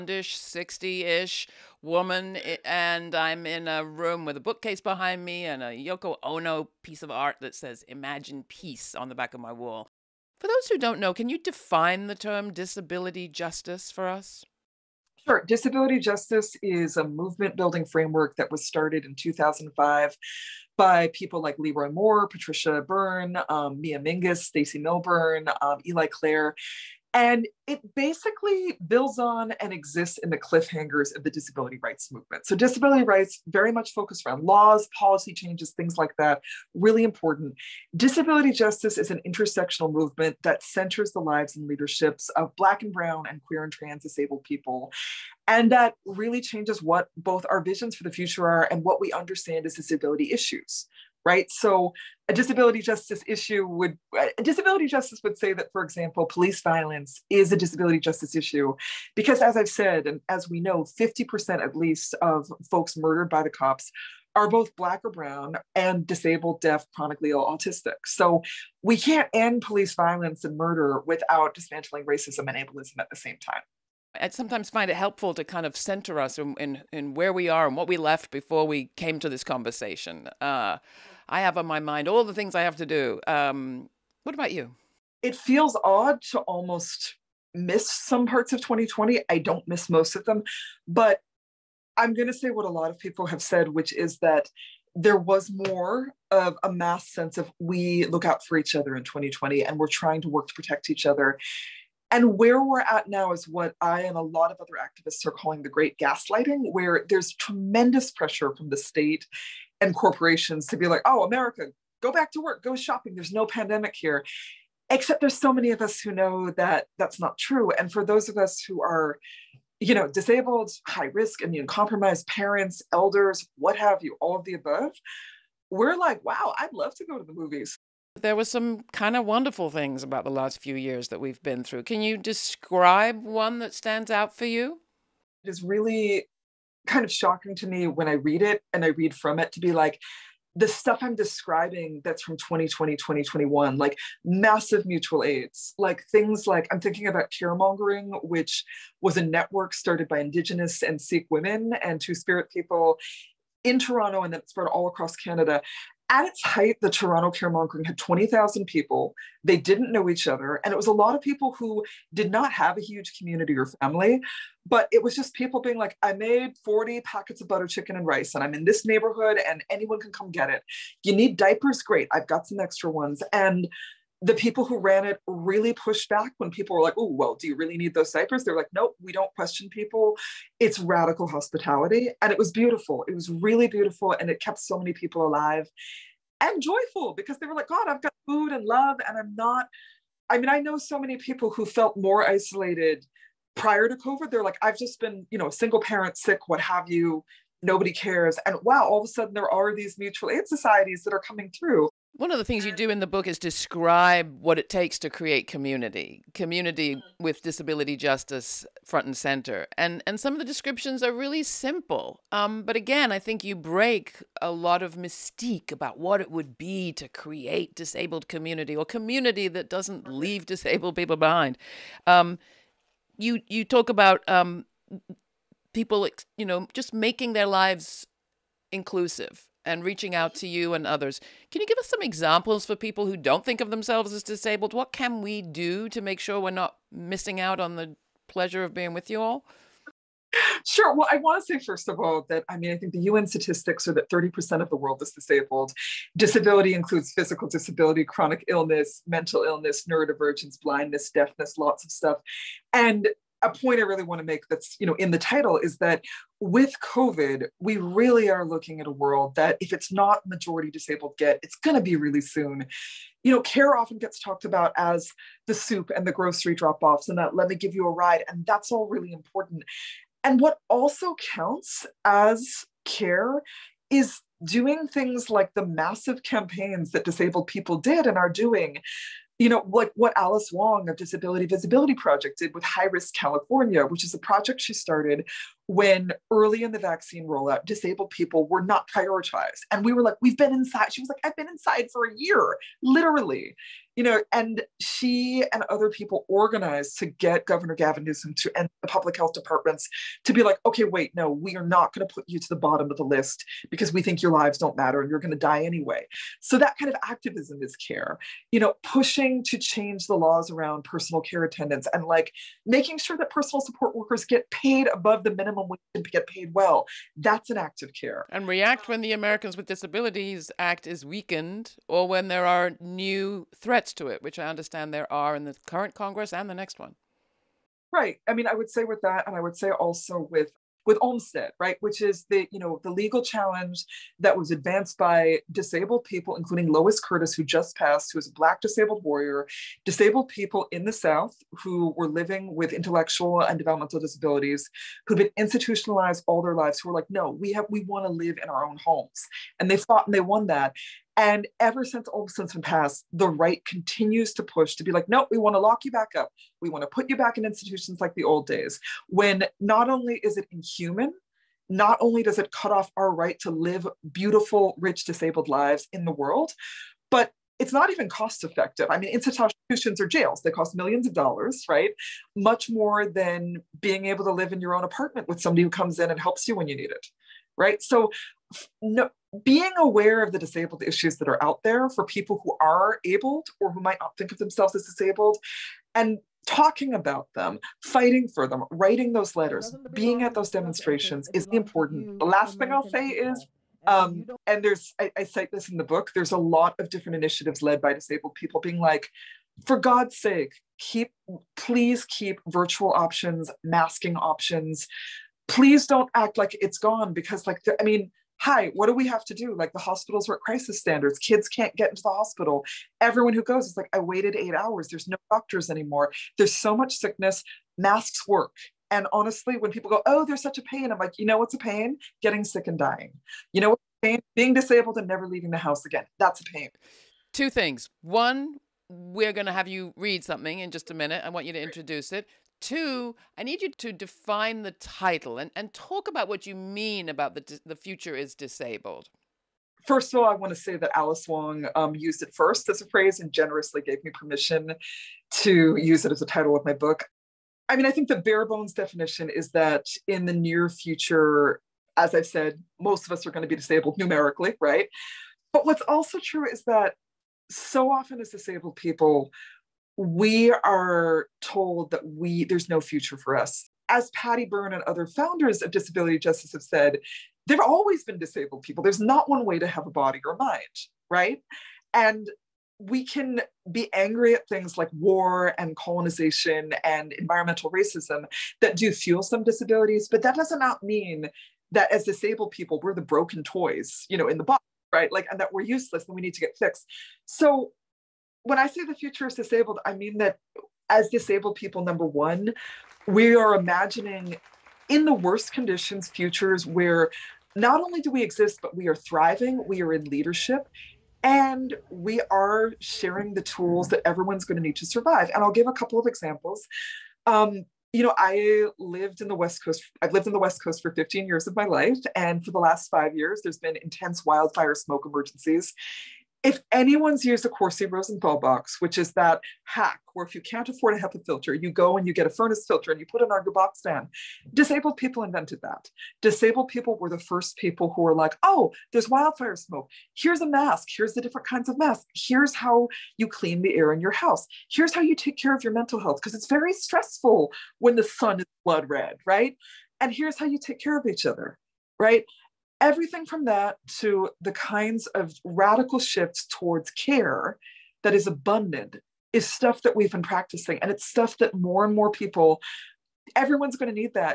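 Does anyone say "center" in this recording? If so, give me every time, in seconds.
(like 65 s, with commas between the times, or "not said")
40 s, 75 s, 209 s.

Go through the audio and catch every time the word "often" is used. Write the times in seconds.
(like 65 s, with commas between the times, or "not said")
263 s, 457 s.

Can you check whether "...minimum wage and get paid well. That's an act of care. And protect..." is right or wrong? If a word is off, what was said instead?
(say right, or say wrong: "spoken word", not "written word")
wrong: "react", not "protect".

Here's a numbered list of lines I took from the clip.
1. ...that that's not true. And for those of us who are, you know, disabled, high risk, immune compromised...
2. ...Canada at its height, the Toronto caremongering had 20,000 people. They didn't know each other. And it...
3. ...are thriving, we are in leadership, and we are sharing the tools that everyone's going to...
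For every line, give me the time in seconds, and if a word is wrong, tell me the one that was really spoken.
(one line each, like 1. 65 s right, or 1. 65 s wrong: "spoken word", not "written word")
1. 116 s right
2. 155 s right
3. 498 s right.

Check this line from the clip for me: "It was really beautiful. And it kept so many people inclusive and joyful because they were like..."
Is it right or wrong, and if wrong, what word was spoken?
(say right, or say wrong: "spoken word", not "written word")
wrong: "alive", not "inclusive".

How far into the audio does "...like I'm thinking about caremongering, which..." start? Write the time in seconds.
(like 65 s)
146 s.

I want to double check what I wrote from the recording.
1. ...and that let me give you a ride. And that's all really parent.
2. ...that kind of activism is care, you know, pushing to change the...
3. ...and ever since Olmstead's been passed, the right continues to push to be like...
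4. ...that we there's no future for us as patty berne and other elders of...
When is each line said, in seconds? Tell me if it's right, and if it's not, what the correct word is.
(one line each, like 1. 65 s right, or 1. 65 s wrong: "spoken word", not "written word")
1. 267 s wrong: "important", not "parent"
2. 306 s right
3. 351 s right
4. 461 s wrong: "founders", not "elders".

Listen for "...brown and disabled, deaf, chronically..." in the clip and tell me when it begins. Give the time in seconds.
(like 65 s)
65 s.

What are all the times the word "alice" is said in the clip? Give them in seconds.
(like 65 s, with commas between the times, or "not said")
280 s, 440 s.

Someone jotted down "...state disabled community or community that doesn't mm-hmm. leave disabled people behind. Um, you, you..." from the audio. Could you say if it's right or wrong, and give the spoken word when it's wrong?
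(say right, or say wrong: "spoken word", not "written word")
wrong: "create", not "state".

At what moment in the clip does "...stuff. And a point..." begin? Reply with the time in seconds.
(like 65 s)
251 s.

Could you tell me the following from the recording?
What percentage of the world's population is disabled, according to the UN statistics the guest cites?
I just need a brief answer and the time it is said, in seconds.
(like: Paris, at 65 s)
30%, at 244 s.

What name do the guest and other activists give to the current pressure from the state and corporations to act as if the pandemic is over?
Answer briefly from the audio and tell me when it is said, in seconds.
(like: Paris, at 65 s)
the great gaslighting, at 105 s.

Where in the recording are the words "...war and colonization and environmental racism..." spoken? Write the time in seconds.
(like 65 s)
474 s.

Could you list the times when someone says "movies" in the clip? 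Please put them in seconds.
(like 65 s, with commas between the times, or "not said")
127 s.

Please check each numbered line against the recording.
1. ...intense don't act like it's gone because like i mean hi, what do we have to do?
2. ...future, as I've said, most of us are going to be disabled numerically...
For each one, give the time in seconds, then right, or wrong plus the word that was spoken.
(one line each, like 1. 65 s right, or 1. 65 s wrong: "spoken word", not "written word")
1. 405 s wrong: "please", not "intense"
2. 450 s right.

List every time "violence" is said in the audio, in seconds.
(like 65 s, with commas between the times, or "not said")
56 s, 69 s.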